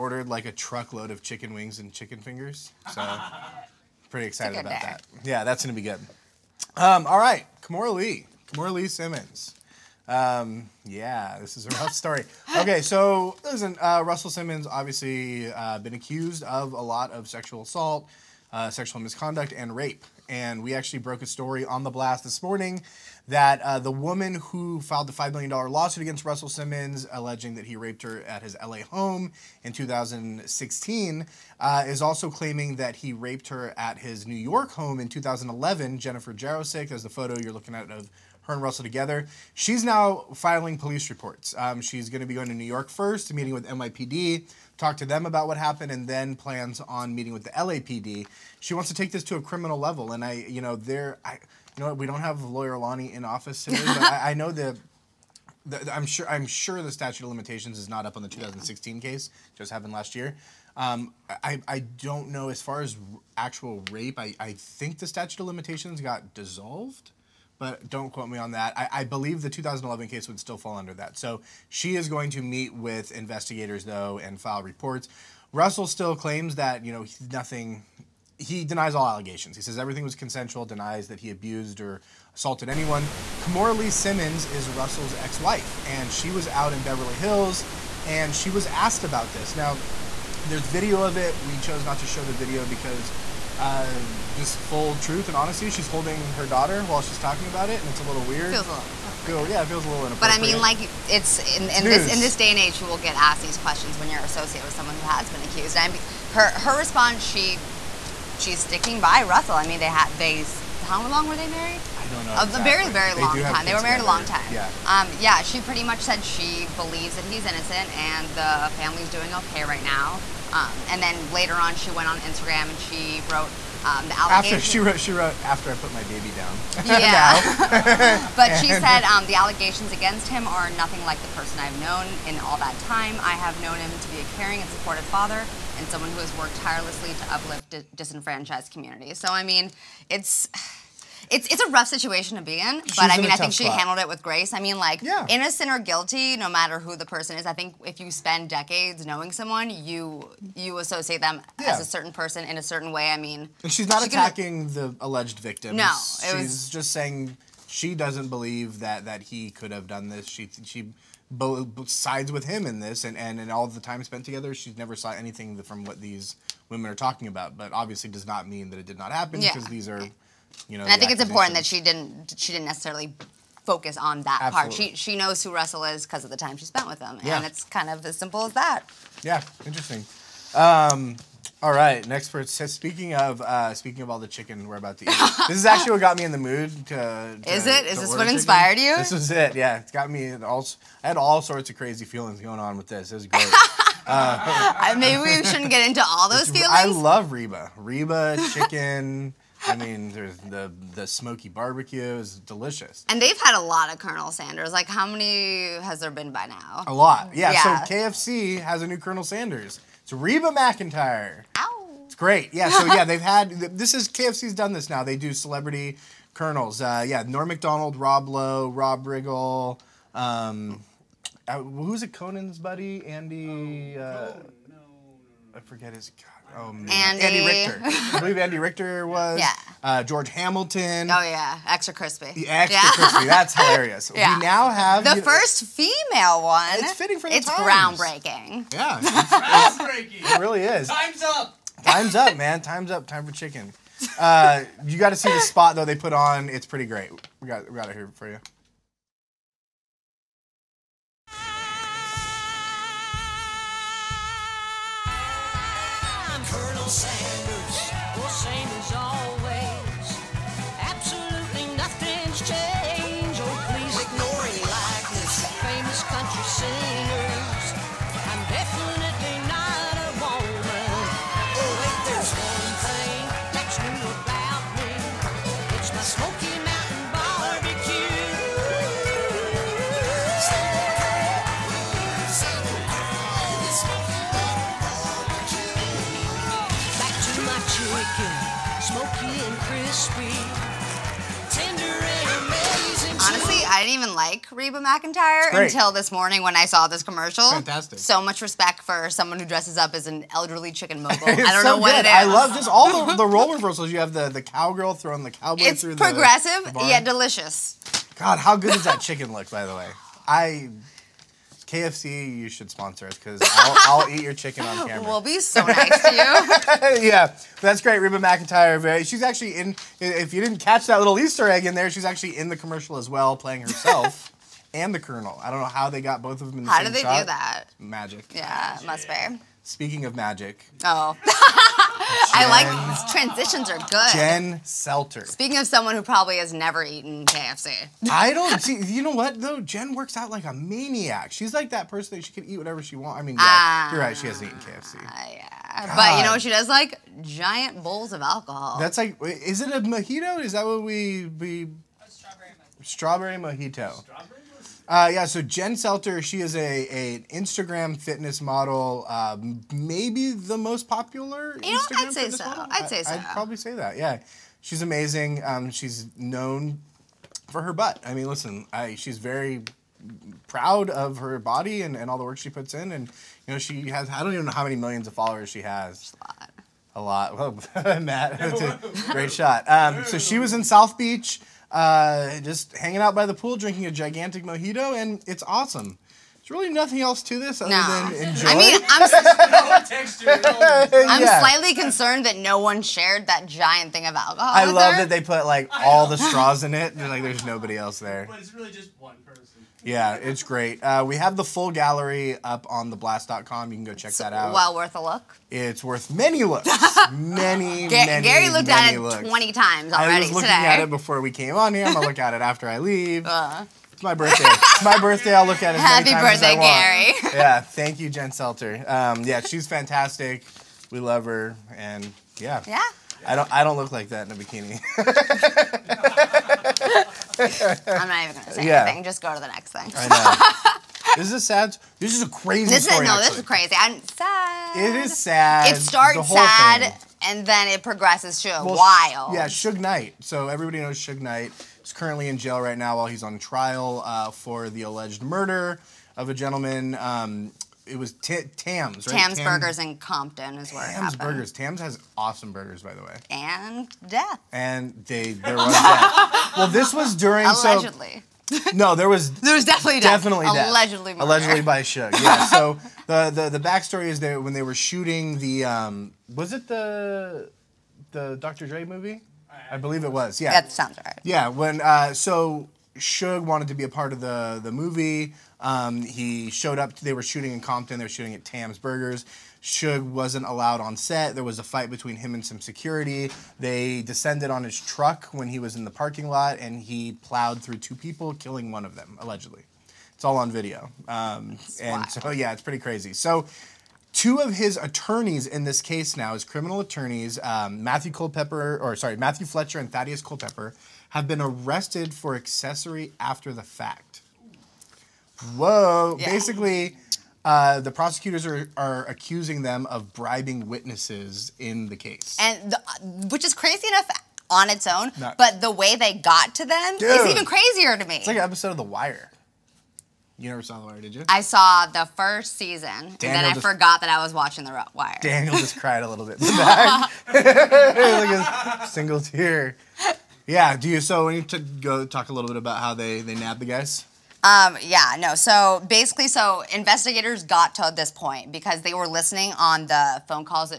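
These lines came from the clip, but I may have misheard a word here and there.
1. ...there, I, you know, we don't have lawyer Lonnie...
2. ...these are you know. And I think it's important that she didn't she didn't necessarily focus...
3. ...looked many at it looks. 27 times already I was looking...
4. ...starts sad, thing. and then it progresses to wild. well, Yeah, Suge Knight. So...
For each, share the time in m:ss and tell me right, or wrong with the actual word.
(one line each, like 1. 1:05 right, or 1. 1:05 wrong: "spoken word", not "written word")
1. 0:50 right
2. 2:49 right
3. 6:48 wrong: "20", not "27"
4. 7:15 right.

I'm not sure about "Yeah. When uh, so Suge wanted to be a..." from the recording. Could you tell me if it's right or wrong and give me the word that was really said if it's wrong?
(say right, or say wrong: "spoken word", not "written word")
right.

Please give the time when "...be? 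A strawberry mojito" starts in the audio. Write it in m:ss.
5:51.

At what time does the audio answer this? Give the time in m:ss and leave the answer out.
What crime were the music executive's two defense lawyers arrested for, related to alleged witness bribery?
8:22.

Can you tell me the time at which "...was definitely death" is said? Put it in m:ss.
7:39.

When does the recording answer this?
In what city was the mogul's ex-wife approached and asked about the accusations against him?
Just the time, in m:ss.
1:26.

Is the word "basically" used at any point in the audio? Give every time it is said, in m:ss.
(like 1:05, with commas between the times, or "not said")
8:26, 8:55.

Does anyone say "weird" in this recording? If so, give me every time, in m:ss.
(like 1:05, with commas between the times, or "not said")
1:38.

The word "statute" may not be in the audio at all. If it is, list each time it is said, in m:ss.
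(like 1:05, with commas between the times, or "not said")
0:56, 1:05.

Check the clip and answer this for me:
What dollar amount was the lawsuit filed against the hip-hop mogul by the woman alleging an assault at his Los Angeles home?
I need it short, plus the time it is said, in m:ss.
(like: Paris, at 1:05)
$5 million, at 0:25.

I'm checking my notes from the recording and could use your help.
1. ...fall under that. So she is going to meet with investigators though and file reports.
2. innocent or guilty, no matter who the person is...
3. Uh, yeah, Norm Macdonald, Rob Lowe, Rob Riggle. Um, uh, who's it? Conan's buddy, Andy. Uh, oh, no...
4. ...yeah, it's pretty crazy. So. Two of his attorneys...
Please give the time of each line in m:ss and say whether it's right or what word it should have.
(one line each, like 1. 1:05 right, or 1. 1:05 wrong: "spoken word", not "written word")
1. 1:10 right
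2. 2:25 right
3. 3:36 right
4. 8:12 right.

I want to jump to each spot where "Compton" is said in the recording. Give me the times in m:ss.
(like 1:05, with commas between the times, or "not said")
7:29, 7:57.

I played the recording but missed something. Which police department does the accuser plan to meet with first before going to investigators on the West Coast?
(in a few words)
NYPD.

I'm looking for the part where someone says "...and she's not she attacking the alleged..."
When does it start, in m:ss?
2:33.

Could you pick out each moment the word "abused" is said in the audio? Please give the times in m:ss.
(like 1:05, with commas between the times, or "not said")
1:21.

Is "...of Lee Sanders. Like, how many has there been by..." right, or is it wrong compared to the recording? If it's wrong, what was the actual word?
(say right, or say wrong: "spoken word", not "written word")
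wrong: "Colonel", not "Lee".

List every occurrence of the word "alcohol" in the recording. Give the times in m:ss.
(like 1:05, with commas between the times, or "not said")
5:48, 6:34.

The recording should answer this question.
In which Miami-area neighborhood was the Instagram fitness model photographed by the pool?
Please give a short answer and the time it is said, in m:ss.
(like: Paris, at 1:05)
South Beach, at 6:20.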